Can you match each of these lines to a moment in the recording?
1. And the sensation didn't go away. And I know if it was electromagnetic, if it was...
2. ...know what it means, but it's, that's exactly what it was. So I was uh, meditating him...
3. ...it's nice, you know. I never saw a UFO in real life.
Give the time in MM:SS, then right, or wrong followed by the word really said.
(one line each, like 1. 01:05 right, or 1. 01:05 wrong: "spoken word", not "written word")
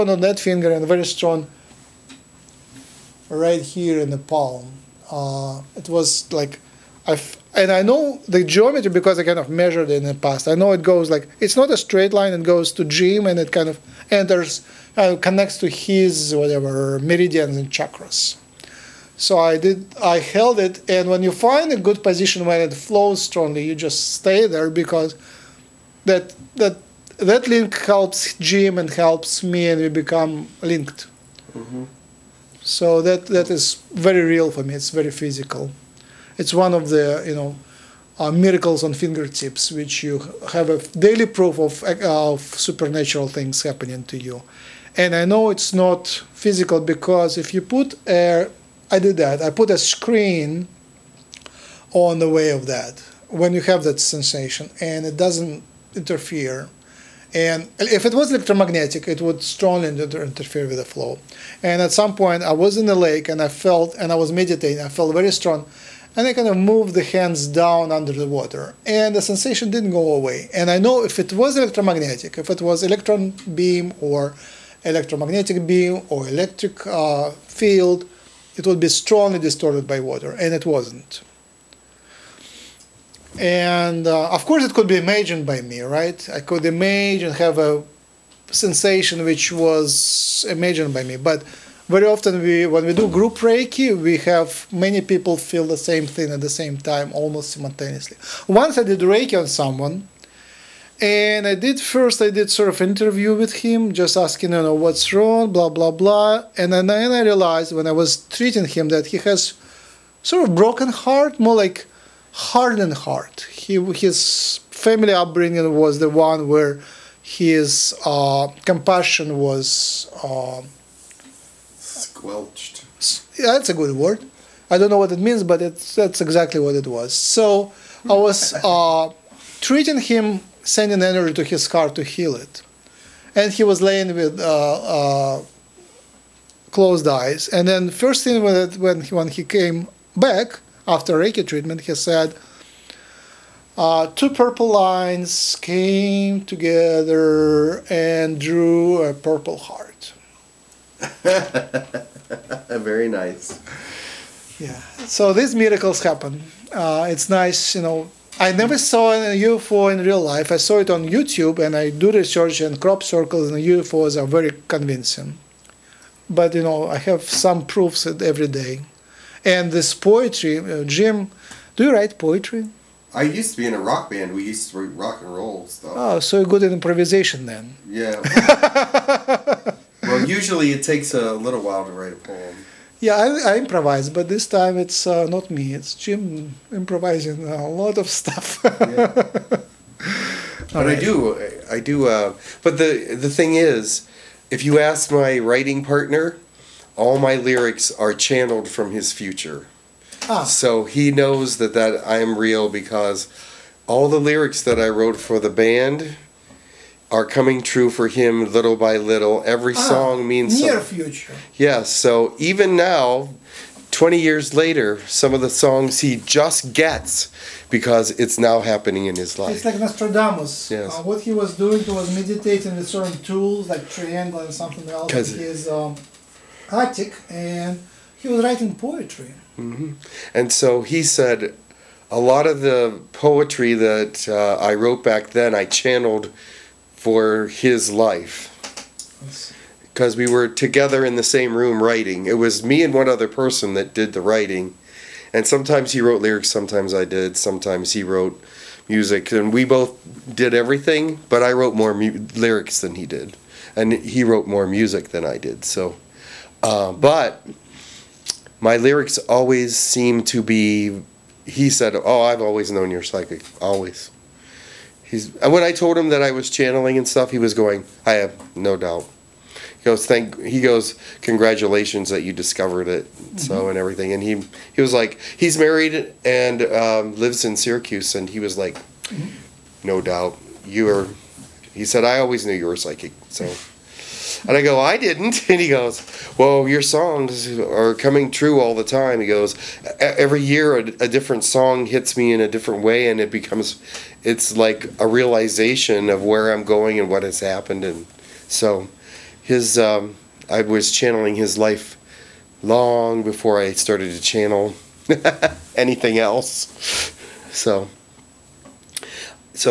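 1. 01:08 right
2. 02:04 wrong: "treating", not "meditating"
3. 02:37 right.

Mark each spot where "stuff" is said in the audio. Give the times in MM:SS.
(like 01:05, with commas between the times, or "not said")
02:55, 03:08, 04:27.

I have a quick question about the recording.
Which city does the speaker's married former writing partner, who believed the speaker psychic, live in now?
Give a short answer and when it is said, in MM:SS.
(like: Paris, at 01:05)
Syracuse, at 04:37.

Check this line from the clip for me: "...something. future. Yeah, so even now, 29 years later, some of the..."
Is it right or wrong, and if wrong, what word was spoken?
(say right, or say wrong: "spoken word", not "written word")
wrong: "20", not "29".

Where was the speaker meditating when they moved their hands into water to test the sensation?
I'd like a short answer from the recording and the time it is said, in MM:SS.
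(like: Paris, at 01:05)
In the lake, at 01:02.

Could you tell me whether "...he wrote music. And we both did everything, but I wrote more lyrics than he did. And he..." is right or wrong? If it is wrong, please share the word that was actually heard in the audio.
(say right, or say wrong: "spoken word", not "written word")
right.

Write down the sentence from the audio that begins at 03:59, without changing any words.
Because we were together in the same room writing.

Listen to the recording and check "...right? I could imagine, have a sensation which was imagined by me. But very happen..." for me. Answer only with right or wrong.
wrong.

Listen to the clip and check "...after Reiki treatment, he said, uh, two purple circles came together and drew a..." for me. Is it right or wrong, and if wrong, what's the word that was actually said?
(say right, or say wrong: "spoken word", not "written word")
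wrong: "lines", not "circles".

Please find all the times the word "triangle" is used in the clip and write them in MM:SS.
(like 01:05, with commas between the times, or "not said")
03:43.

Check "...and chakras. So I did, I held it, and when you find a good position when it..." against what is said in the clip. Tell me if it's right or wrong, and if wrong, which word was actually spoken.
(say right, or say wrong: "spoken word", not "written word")
right.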